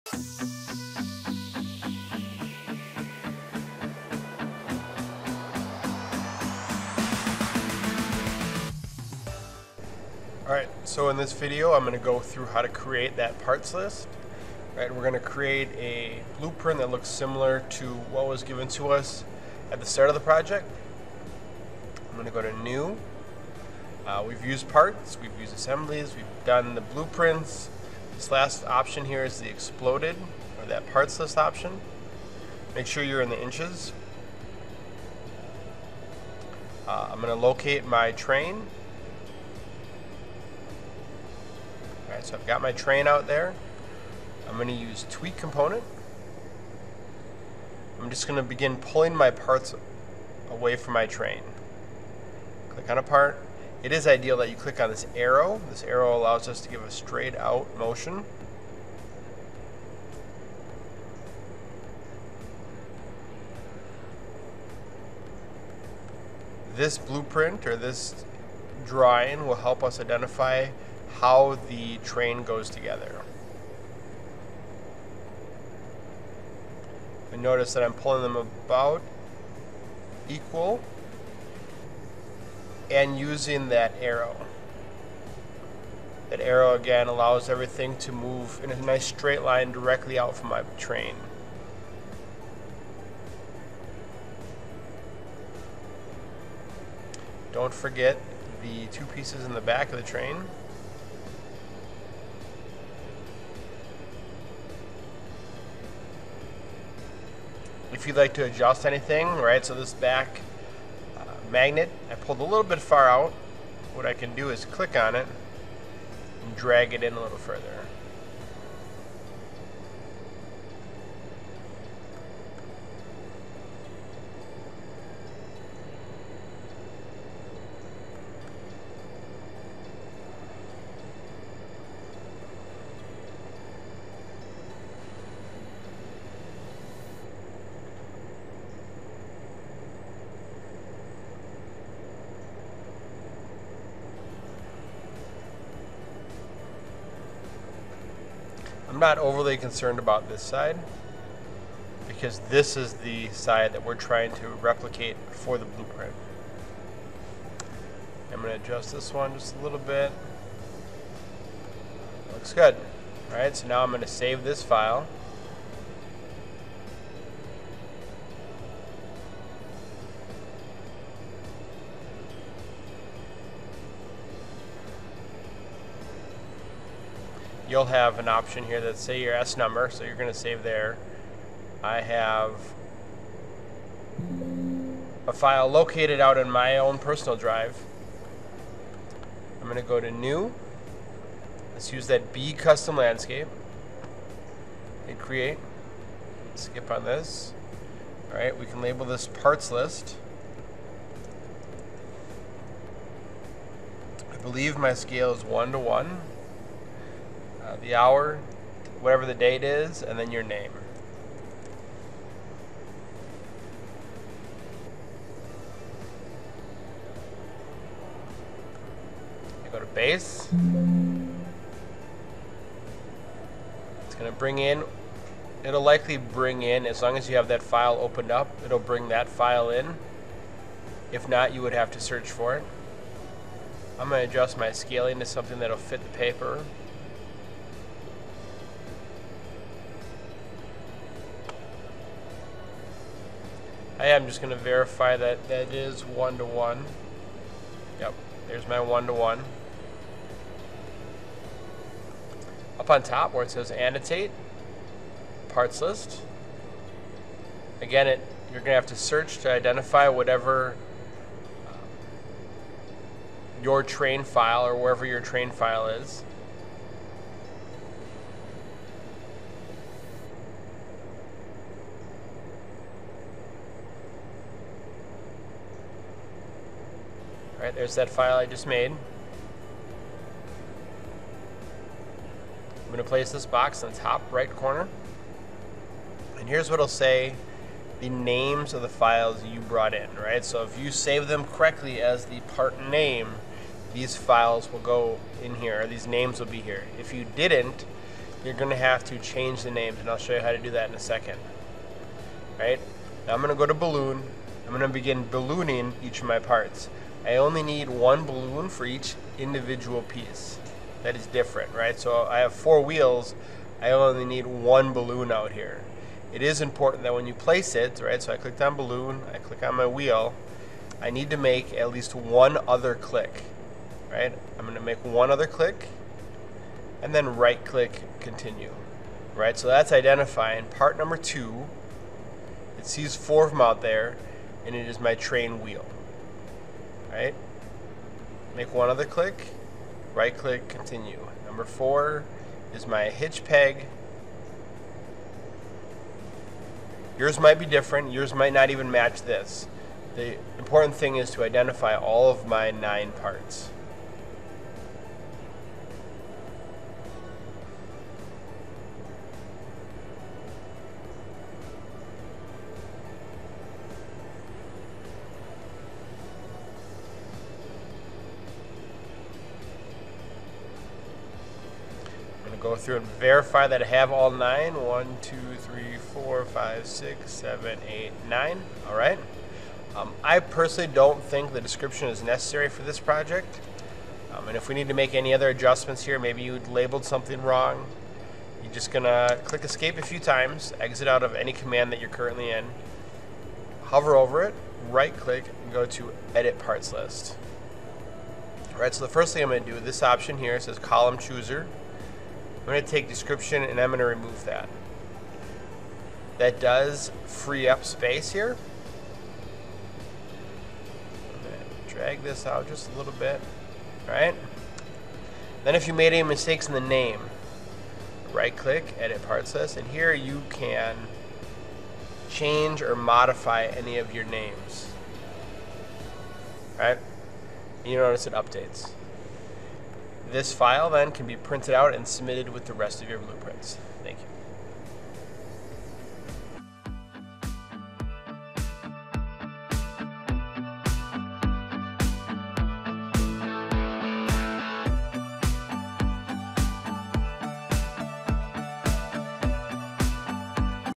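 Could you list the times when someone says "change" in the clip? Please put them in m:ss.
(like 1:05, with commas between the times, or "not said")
4:59, 7:02.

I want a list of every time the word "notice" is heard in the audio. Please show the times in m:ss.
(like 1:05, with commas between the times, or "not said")
1:17, 7:07.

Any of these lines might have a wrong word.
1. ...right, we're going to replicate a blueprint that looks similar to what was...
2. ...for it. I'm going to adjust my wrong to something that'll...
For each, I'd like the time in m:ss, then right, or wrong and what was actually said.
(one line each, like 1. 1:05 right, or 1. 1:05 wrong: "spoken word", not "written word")
1. 0:14 wrong: "create", not "replicate"
2. 3:52 wrong: "scaling", not "wrong".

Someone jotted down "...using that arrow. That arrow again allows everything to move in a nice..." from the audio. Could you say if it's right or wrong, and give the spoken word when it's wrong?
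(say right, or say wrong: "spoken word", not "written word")
right.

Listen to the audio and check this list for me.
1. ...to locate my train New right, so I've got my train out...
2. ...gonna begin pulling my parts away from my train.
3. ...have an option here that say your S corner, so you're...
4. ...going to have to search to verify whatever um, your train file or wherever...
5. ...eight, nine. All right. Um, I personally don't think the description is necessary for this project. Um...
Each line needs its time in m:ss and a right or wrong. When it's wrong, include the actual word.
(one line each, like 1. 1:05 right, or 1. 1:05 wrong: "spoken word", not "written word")
1. 0:37 wrong: "All", not "New"
2. 0:48 right
3. 2:57 wrong: "number", not "corner"
4. 4:18 wrong: "identify", not "verify"
5. 6:17 right.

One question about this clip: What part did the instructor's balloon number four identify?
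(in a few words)
hitch peg.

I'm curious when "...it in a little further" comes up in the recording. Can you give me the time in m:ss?
1:56.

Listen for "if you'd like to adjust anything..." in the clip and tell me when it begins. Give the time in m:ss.
1:48.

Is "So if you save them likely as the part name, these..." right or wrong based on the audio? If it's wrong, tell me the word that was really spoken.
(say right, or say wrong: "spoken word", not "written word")
wrong: "correctly", not "likely".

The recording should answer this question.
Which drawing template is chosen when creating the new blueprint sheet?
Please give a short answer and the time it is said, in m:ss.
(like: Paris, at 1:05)
B Custom Landscape, at 3:12.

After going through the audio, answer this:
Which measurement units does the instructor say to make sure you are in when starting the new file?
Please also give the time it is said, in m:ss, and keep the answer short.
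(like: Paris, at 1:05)
inches, at 0:33.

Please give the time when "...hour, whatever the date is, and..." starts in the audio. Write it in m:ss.
3:27.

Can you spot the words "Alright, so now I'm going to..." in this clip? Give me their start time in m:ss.
2:43.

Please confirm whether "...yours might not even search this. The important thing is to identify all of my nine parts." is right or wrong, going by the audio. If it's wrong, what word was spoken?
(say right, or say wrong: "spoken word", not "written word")
wrong: "match", not "search".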